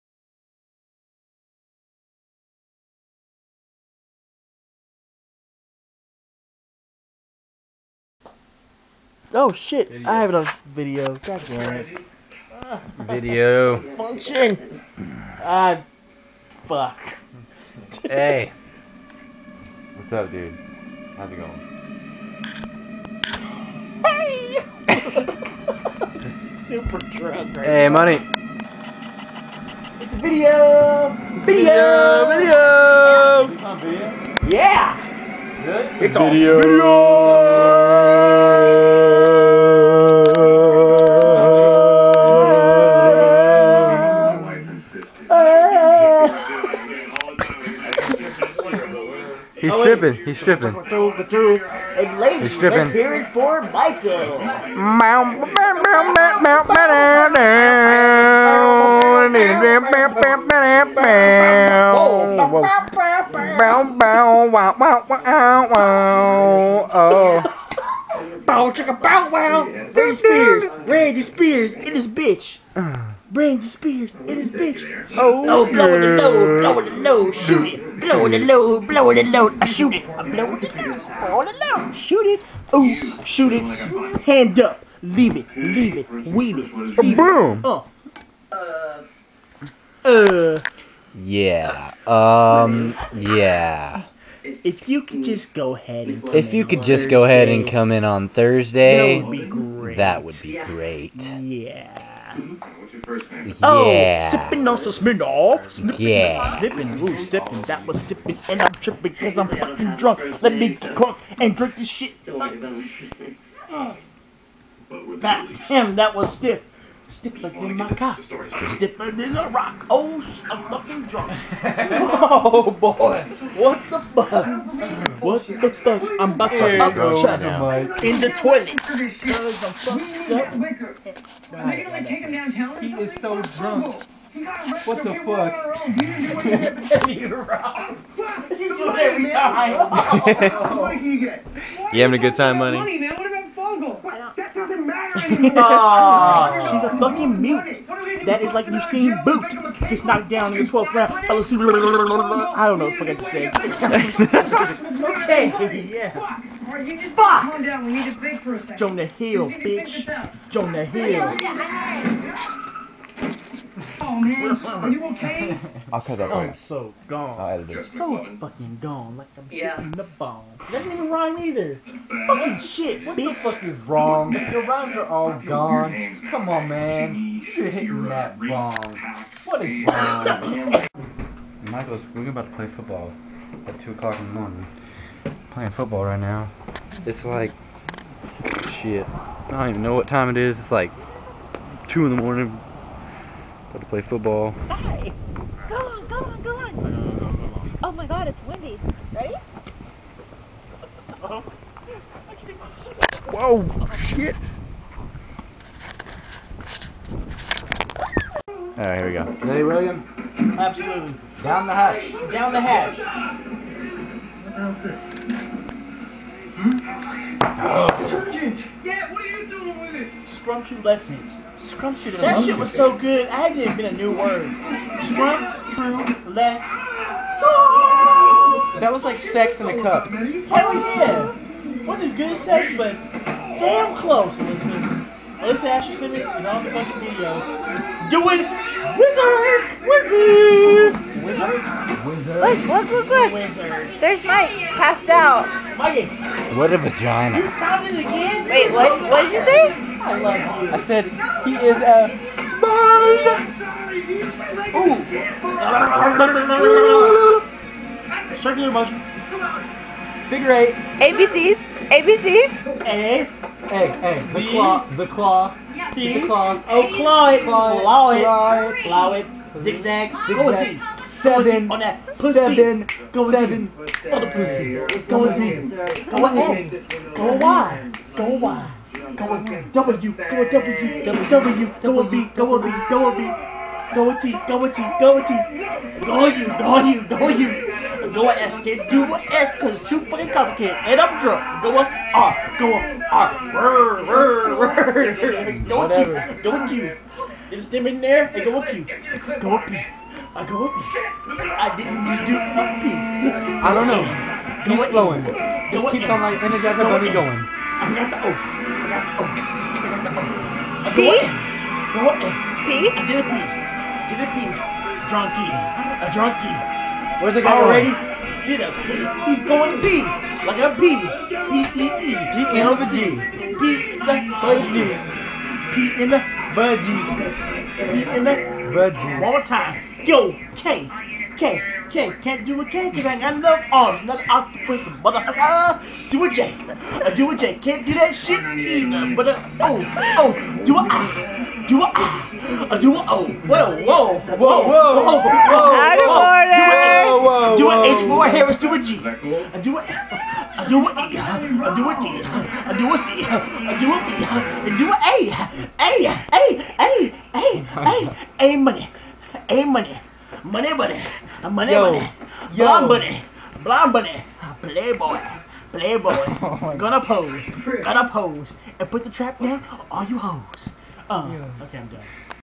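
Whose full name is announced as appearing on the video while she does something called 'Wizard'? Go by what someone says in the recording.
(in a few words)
Alyssa Ashley Simmons.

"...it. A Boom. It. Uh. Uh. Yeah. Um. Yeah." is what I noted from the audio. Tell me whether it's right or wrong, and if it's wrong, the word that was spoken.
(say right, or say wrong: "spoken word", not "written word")
right.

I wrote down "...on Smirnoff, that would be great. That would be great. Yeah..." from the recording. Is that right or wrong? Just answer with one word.
wrong.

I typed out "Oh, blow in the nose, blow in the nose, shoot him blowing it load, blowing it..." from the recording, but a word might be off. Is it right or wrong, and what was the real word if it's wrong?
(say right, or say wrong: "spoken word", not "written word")
right.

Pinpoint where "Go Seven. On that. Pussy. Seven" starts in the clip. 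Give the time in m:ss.
4:30.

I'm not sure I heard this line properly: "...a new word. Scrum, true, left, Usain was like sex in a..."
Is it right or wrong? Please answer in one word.
wrong.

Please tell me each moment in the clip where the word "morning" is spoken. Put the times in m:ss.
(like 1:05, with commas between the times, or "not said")
3:04, 3:12.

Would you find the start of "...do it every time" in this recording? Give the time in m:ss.
2:18.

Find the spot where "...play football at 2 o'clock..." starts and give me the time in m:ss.
3:02.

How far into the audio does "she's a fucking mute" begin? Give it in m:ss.
2:25.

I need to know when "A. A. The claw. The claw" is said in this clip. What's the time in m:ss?
4:23.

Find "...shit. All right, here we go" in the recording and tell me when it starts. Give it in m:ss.
3:23.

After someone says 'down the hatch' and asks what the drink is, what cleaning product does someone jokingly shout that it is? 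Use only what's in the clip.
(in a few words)
Detergent.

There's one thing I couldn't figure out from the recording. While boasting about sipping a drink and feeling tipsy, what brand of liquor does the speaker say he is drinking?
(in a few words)
Smirnoff.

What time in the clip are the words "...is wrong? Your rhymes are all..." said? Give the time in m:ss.
2:53.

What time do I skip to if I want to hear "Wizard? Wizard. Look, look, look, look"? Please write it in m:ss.
4:01.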